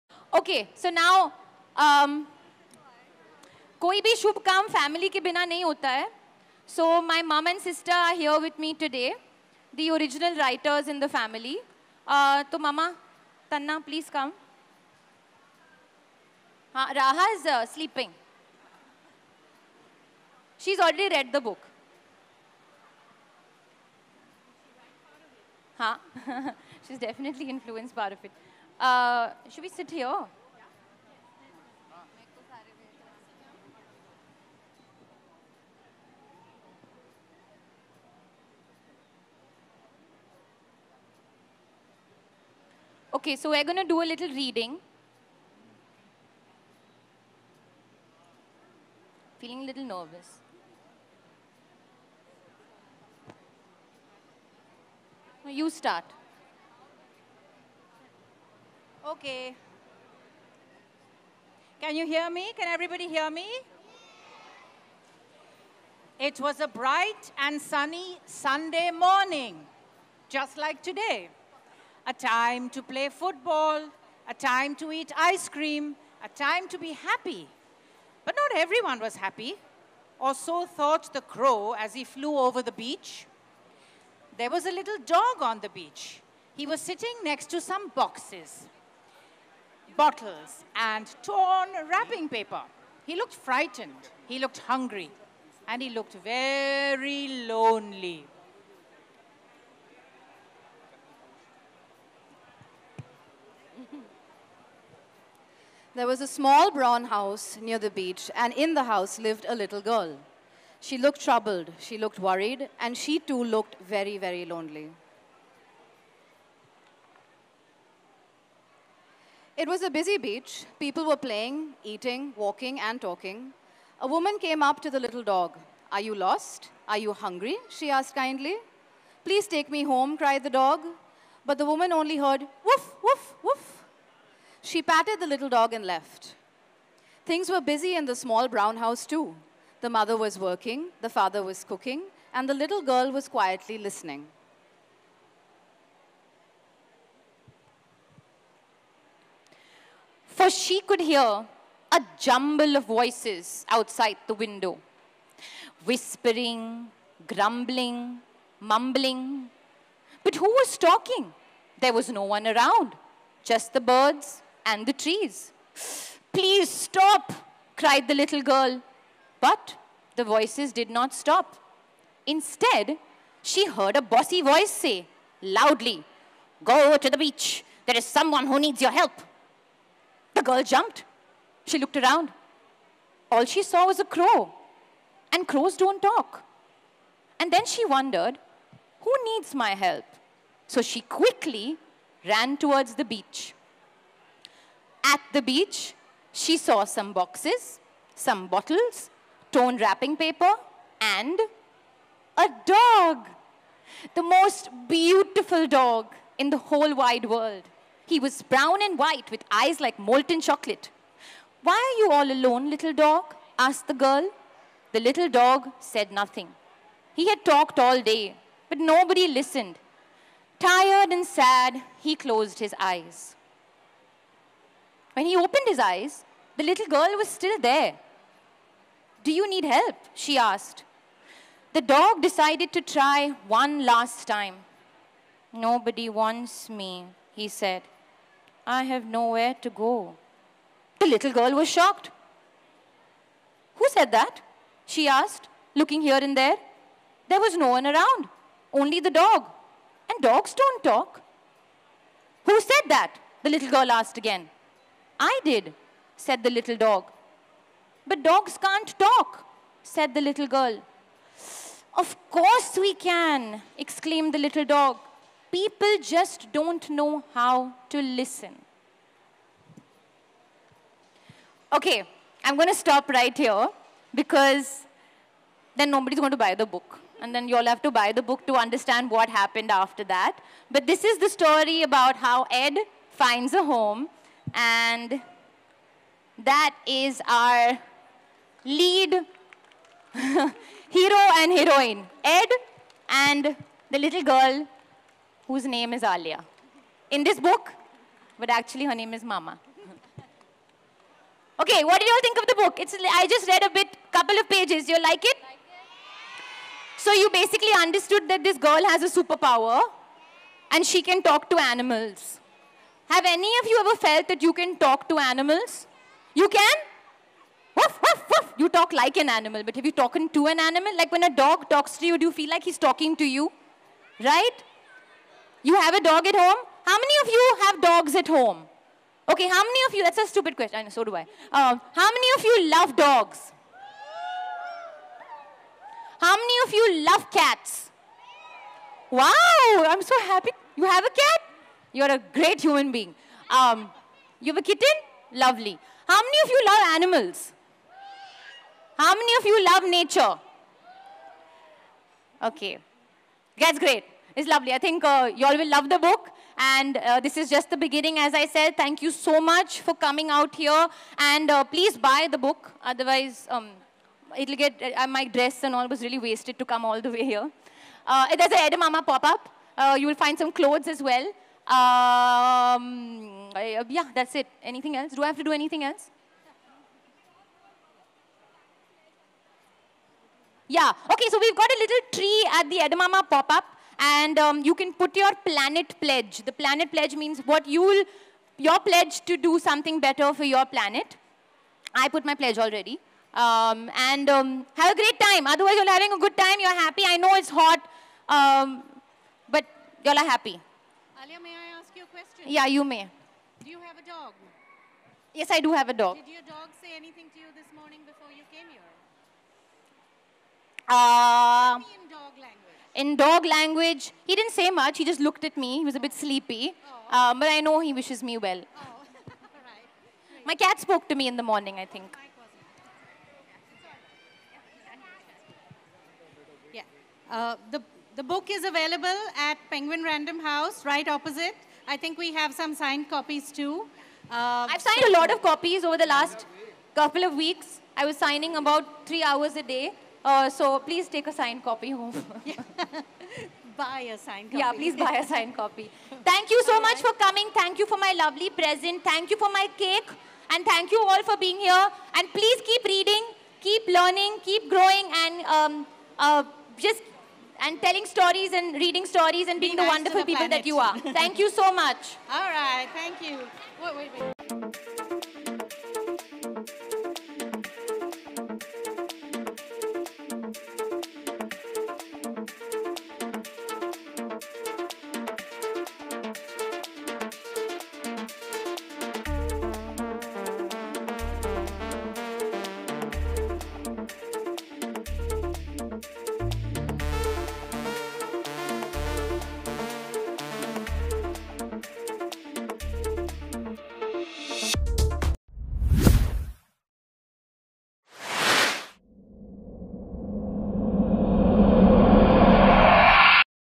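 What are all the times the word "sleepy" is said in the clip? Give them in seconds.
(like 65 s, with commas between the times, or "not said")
416 s.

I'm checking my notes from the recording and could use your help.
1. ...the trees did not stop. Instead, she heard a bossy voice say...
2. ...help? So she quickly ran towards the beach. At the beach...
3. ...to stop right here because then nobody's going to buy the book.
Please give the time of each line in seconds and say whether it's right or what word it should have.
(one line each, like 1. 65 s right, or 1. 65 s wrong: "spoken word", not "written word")
1. 170 s wrong: "voices", not "trees"
2. 189 s right
3. 272 s right.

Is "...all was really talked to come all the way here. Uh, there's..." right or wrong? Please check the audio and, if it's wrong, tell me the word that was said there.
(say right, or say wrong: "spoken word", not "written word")
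wrong: "wasted", not "talked".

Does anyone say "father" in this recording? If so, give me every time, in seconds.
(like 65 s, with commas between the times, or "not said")
141 s.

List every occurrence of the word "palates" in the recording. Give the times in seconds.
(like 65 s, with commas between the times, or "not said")
not said.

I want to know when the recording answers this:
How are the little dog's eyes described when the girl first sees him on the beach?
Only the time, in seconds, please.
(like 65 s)
209 s.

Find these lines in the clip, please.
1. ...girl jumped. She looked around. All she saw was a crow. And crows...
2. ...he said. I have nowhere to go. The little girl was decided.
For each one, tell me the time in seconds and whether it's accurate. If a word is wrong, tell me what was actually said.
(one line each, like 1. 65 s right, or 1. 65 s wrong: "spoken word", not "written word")
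1. 180 s right
2. 237 s wrong: "shocked", not "decided".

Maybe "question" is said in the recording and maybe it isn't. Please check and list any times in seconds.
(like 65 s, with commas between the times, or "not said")
330 s, 402 s.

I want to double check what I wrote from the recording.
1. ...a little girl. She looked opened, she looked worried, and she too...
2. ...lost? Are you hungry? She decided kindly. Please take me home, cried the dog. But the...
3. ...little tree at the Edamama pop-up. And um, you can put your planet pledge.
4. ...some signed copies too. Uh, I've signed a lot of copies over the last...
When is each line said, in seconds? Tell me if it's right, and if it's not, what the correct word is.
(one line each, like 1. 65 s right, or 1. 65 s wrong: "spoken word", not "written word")
1. 109 s wrong: "troubled", not "opened"
2. 126 s wrong: "asked", not "decided"
3. 381 s right
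4. 432 s right.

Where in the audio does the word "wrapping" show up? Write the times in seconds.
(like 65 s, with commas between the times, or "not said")
91 s, 199 s.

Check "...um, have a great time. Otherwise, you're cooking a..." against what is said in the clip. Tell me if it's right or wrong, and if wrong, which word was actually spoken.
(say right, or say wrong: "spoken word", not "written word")
wrong: "having", not "cooking".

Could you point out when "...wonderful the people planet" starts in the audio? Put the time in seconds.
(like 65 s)
459 s.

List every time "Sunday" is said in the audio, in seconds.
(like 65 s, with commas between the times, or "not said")
68 s.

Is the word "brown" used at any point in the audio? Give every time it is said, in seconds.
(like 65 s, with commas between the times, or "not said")
106 s, 138 s, 208 s.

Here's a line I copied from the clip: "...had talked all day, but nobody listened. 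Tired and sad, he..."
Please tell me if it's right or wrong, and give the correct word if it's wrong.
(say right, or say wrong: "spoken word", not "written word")
right.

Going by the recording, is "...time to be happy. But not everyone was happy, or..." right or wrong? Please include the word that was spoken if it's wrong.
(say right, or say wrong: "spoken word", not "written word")
right.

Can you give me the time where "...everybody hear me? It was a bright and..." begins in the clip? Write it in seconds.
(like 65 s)
62 s.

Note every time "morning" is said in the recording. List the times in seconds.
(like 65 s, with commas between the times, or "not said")
68 s, 407 s, 421 s.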